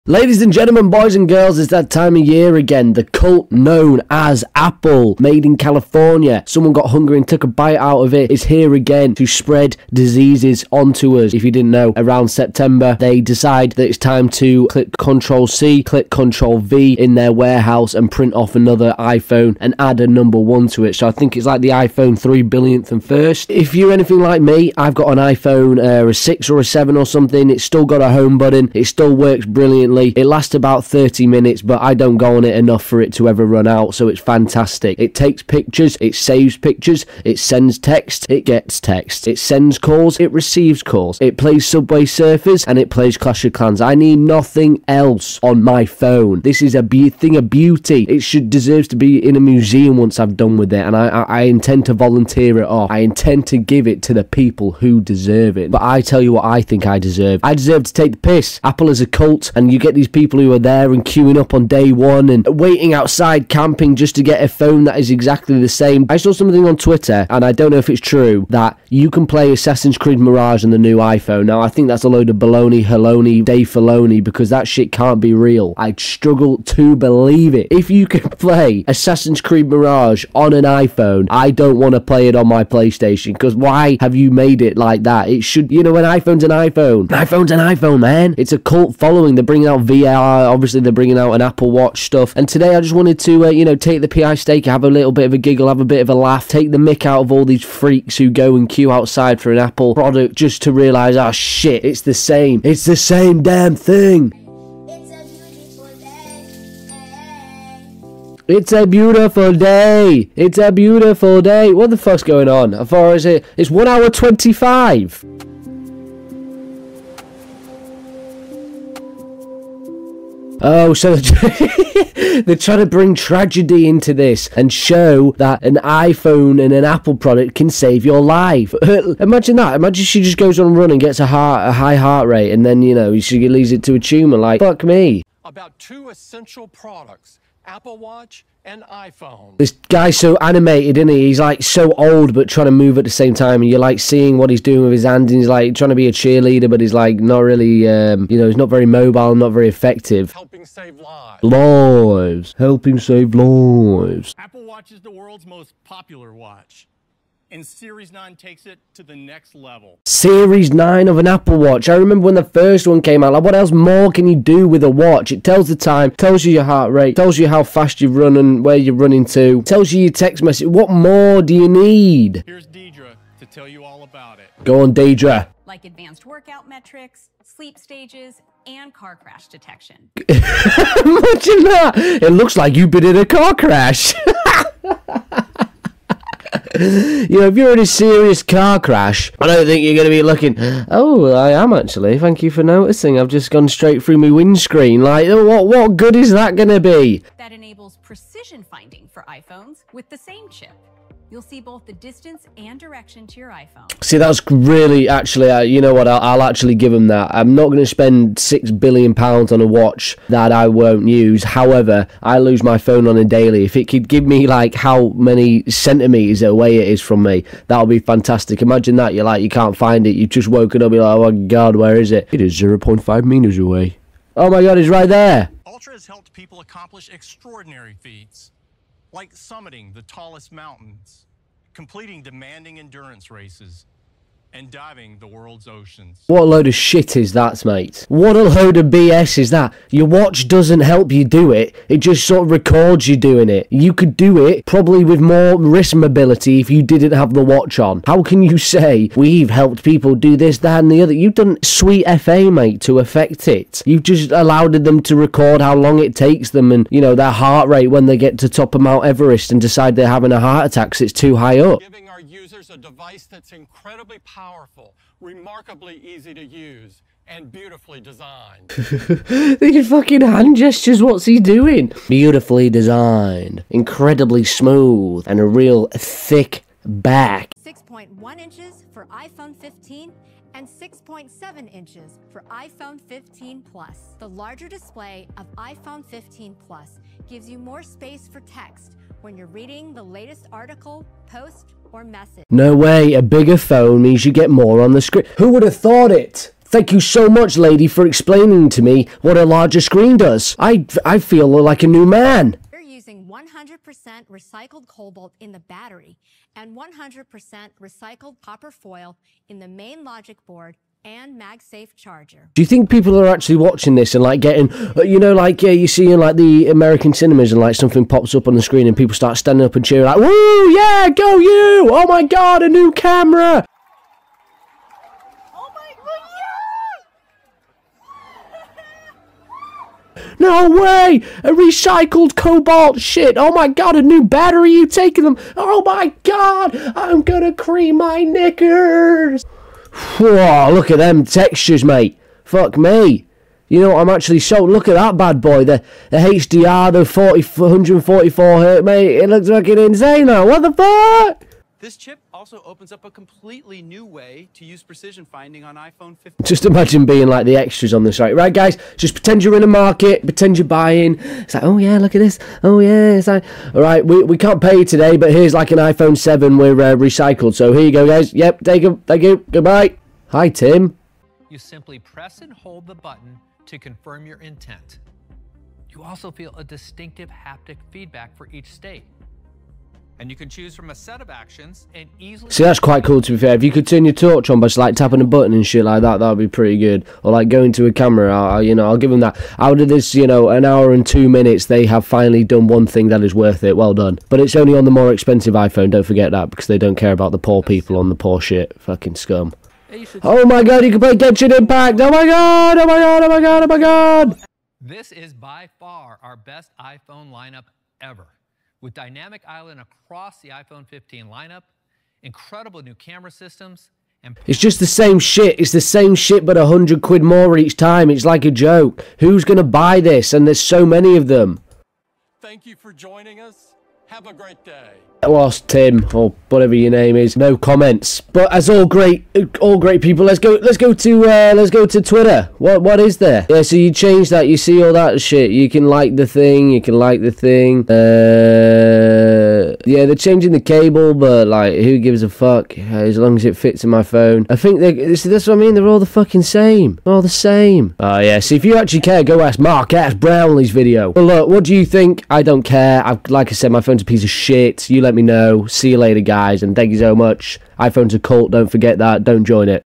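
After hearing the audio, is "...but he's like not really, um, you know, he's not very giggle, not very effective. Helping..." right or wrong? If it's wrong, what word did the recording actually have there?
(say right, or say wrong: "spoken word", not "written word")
wrong: "mobile", not "giggle".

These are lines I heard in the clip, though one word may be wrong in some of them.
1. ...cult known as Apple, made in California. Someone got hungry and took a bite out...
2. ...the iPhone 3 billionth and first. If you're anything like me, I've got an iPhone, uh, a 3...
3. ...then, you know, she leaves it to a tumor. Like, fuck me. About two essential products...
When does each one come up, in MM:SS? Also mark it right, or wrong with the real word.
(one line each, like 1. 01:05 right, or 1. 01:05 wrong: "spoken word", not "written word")
1. 00:03 right
2. 00:21 wrong: "6", not "3"
3. 02:12 right.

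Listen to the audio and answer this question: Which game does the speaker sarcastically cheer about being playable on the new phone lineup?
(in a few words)
Genshin Impact.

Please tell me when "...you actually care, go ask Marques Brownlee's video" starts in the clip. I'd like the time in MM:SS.
07:28.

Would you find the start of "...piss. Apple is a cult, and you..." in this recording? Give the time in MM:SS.
00:58.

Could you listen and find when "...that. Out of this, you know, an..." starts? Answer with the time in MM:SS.
06:29.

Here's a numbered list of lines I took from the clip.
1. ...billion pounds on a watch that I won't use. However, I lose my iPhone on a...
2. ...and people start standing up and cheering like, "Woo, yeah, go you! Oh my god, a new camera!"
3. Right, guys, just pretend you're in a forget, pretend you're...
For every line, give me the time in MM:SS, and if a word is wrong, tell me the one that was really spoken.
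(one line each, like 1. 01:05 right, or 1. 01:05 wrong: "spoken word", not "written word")
1. 03:28 wrong: "phone", not "iPhone"
2. 05:18 right
3. 05:58 wrong: "market", not "forget".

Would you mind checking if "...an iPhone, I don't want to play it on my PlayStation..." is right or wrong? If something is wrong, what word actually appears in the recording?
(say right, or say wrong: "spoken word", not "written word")
right.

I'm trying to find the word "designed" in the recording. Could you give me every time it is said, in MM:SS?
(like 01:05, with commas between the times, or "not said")
04:28, 04:32.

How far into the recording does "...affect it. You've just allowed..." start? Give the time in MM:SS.
04:12.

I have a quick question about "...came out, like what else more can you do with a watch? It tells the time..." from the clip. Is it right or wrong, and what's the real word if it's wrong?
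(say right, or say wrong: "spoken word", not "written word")
right.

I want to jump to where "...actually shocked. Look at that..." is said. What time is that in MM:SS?
05:44.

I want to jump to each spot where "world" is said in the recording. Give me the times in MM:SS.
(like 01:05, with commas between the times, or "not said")
02:35, 03:55.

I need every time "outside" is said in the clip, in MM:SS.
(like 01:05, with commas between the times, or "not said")
01:02, 01:38.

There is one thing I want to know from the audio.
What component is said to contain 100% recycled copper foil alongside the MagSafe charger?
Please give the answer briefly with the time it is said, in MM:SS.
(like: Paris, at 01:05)
main logic board, at 05:09.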